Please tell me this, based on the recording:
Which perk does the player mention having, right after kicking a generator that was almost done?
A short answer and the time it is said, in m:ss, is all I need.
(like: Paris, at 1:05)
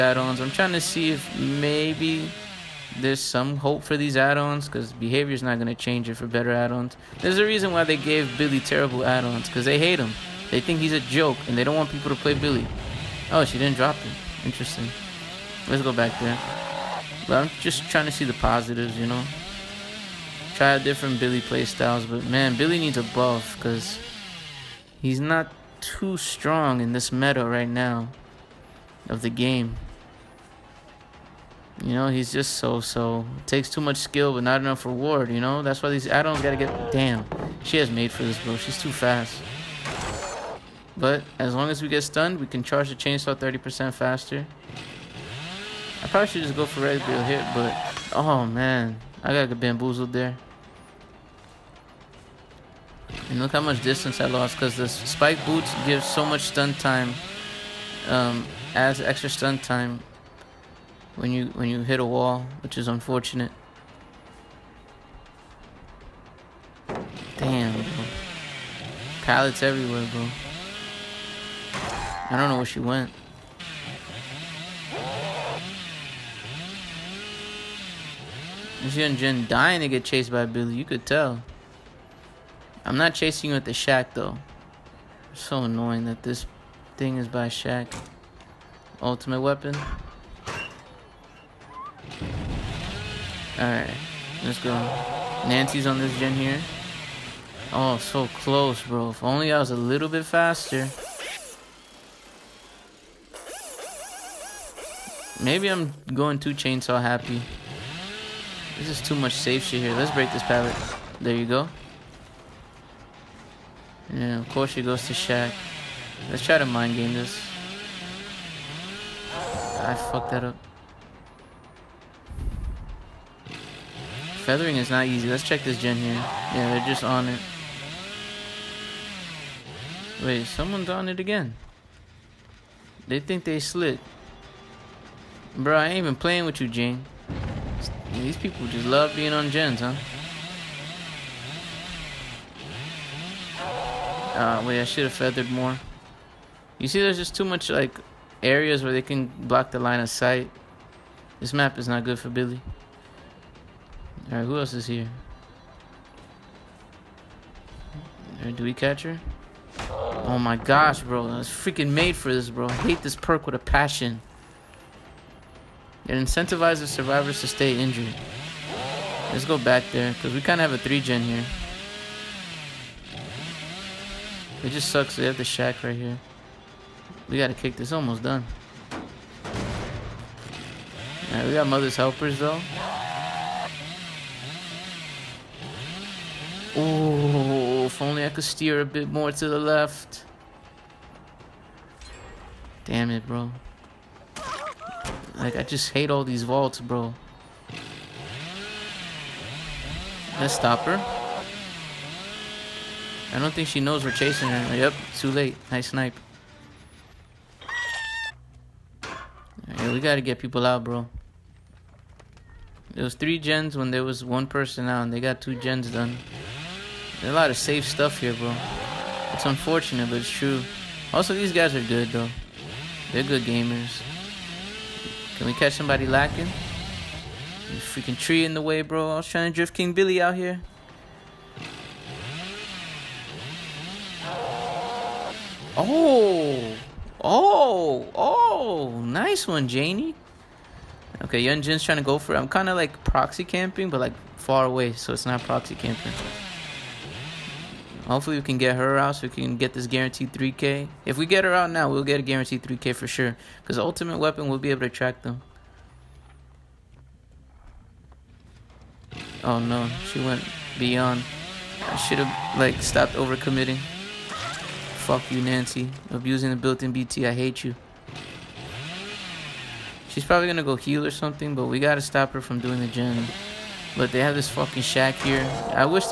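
Mother's Helpers, at 3:01.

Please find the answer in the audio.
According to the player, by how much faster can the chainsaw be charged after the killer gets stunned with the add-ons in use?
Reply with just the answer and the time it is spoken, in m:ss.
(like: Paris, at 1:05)
30%, at 0:43.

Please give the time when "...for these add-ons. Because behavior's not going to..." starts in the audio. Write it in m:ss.
0:03.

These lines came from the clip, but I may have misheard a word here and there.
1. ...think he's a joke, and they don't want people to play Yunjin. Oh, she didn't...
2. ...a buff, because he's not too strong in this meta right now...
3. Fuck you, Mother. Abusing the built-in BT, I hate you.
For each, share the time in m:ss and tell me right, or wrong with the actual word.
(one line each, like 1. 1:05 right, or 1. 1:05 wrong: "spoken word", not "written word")
1. 0:10 wrong: "Billy", not "Yunjin"
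2. 0:22 right
3. 4:23 wrong: "Nancy", not "Mother".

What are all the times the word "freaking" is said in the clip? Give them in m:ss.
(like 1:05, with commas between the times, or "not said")
2:41, 3:47.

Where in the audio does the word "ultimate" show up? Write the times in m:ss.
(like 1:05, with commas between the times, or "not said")
1:29, 4:13.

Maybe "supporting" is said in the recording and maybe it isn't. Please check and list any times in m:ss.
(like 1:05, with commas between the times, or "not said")
not said.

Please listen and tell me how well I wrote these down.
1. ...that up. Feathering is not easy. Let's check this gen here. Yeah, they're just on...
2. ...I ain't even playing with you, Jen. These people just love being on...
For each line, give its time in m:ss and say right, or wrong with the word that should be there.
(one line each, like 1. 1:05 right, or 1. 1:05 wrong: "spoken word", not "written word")
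1. 2:00 right
2. 2:15 wrong: "Gene", not "Jen".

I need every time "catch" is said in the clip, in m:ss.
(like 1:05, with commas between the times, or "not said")
2:38, 3:45.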